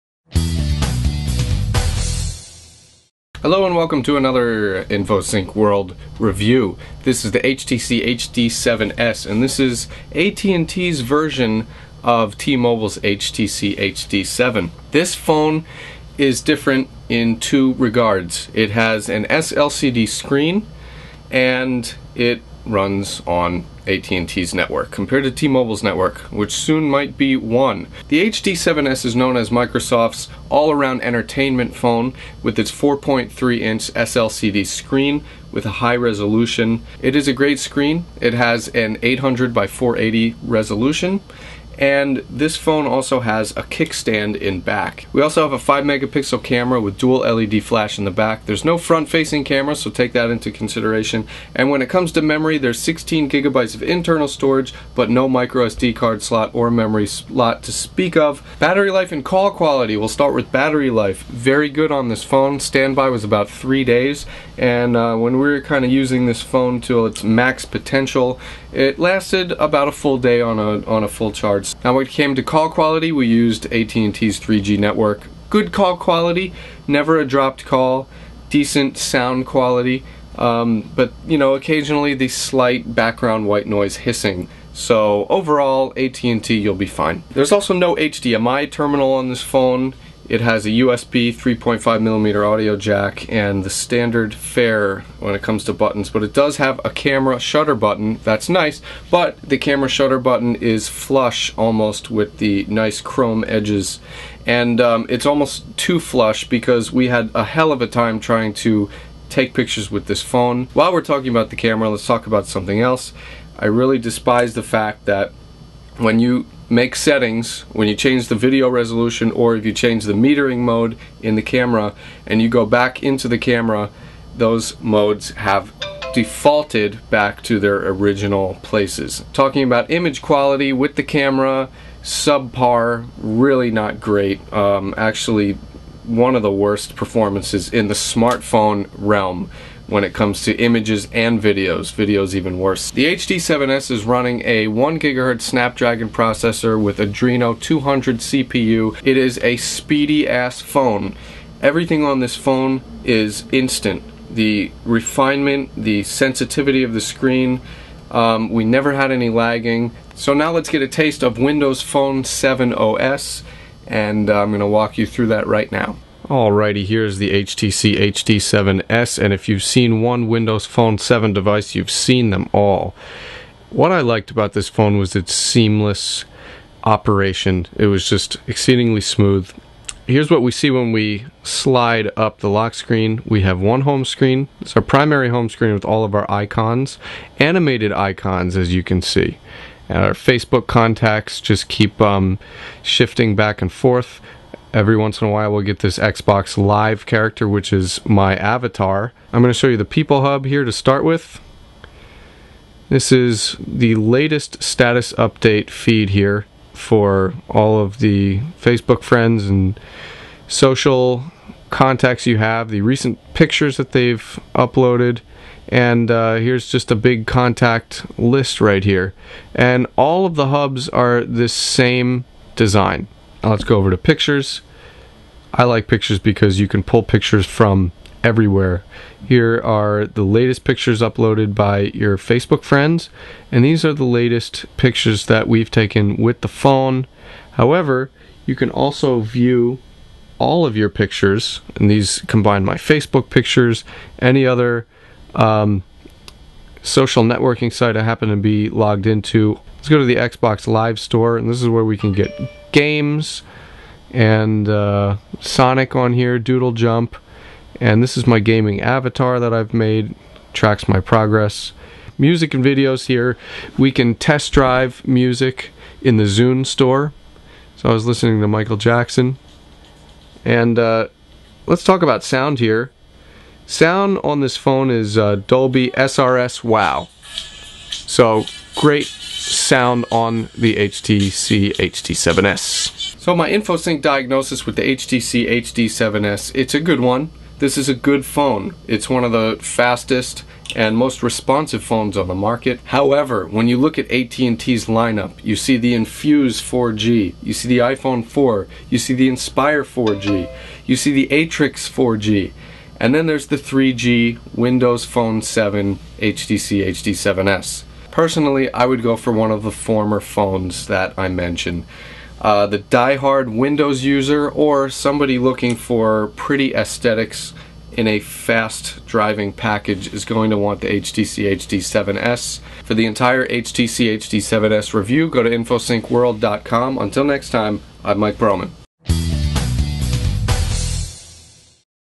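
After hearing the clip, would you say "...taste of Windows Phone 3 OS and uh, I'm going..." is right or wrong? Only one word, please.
wrong.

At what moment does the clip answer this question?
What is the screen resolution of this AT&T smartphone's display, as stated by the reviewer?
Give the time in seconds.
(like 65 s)
39 s.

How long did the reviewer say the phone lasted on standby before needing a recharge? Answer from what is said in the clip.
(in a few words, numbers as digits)
3 days.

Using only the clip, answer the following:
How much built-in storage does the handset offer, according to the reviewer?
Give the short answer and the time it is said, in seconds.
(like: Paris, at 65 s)
16 gigabytes, at 52 s.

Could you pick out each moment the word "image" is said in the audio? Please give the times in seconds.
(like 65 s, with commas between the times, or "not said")
129 s, 140 s.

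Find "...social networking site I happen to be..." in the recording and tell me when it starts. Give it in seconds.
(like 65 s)
246 s.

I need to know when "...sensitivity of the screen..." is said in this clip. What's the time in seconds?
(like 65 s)
156 s.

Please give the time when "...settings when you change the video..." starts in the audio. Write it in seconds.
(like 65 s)
116 s.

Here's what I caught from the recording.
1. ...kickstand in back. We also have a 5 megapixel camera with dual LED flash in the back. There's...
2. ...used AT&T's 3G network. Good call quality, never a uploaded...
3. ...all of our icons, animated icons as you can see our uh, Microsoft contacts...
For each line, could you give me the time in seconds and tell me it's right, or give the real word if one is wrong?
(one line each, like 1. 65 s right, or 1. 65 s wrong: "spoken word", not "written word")
1. 43 s right
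2. 73 s wrong: "dropped", not "uploaded"
3. 185 s wrong: "Facebook", not "Microsoft".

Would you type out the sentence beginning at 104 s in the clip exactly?
And um, it's almost too flush because we had a hell of a time trying to take pictures with this phone.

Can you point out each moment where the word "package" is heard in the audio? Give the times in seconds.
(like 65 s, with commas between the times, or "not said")
319 s.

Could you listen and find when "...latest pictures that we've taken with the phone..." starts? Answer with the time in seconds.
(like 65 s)
234 s.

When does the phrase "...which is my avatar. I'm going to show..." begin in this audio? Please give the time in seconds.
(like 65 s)
197 s.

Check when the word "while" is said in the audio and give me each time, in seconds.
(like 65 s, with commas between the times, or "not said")
110 s, 195 s.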